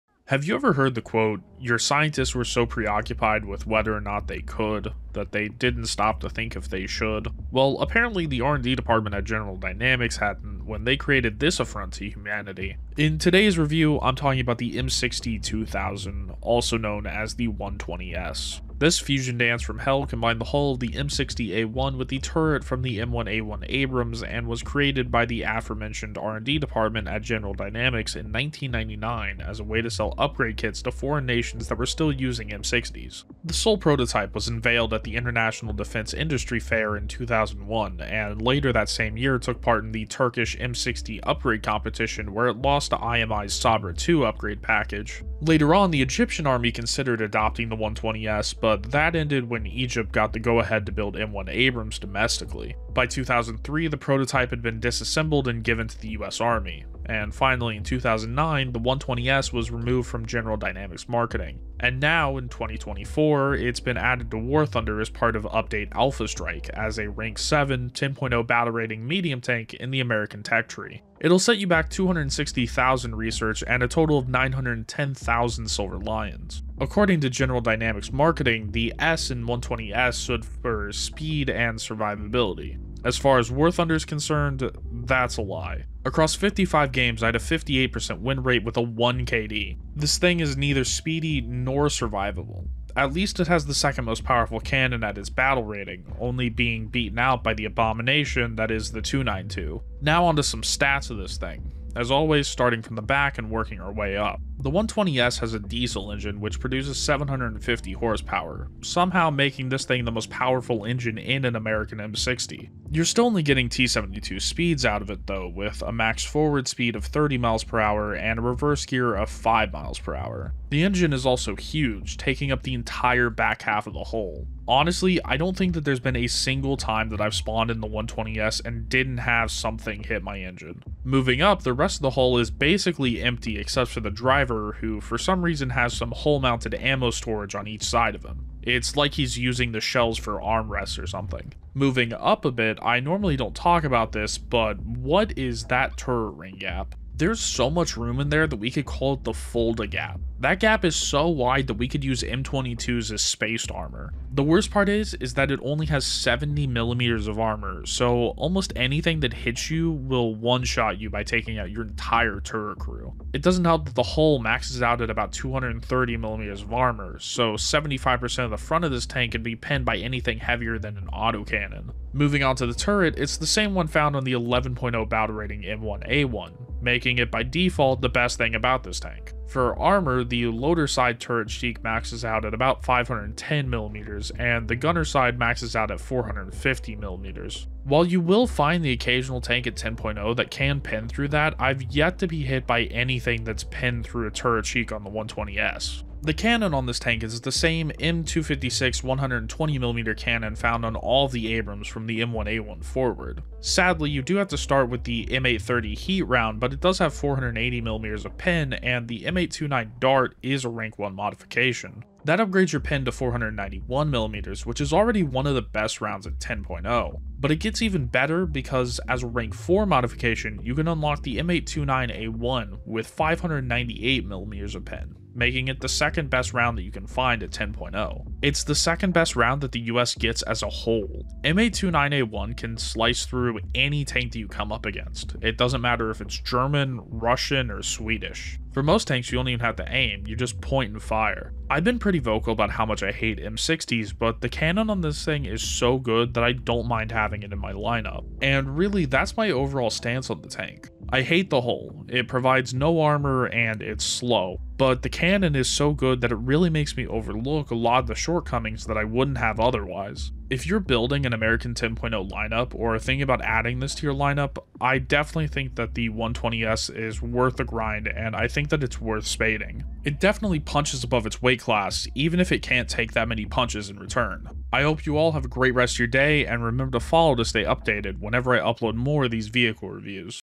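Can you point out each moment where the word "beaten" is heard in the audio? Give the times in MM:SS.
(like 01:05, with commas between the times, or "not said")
01:36.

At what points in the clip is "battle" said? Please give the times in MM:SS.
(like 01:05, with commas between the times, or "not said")
01:08, 01:35, 02:55.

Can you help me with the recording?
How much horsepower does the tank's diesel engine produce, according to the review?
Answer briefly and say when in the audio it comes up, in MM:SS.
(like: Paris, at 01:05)
750, at 01:46.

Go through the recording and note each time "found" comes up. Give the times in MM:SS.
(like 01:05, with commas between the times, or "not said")
02:53, 03:20.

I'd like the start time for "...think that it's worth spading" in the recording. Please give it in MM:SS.
04:28.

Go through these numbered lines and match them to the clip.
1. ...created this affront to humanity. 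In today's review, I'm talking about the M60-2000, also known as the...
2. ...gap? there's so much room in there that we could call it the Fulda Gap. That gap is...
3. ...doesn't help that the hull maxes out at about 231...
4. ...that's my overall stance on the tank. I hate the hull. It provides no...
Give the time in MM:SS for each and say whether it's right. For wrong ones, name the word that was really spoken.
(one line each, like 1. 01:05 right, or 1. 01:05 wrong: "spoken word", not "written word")
1. 00:10 right
2. 02:26 right
3. 02:43 wrong: "230", not "231"
4. 04:09 right.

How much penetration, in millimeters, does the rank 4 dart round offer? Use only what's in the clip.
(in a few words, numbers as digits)
598mm.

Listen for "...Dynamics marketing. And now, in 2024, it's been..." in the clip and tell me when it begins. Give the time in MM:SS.
01:00.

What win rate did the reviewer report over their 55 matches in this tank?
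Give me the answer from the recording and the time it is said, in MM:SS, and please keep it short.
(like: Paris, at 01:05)
58%, at 01:27.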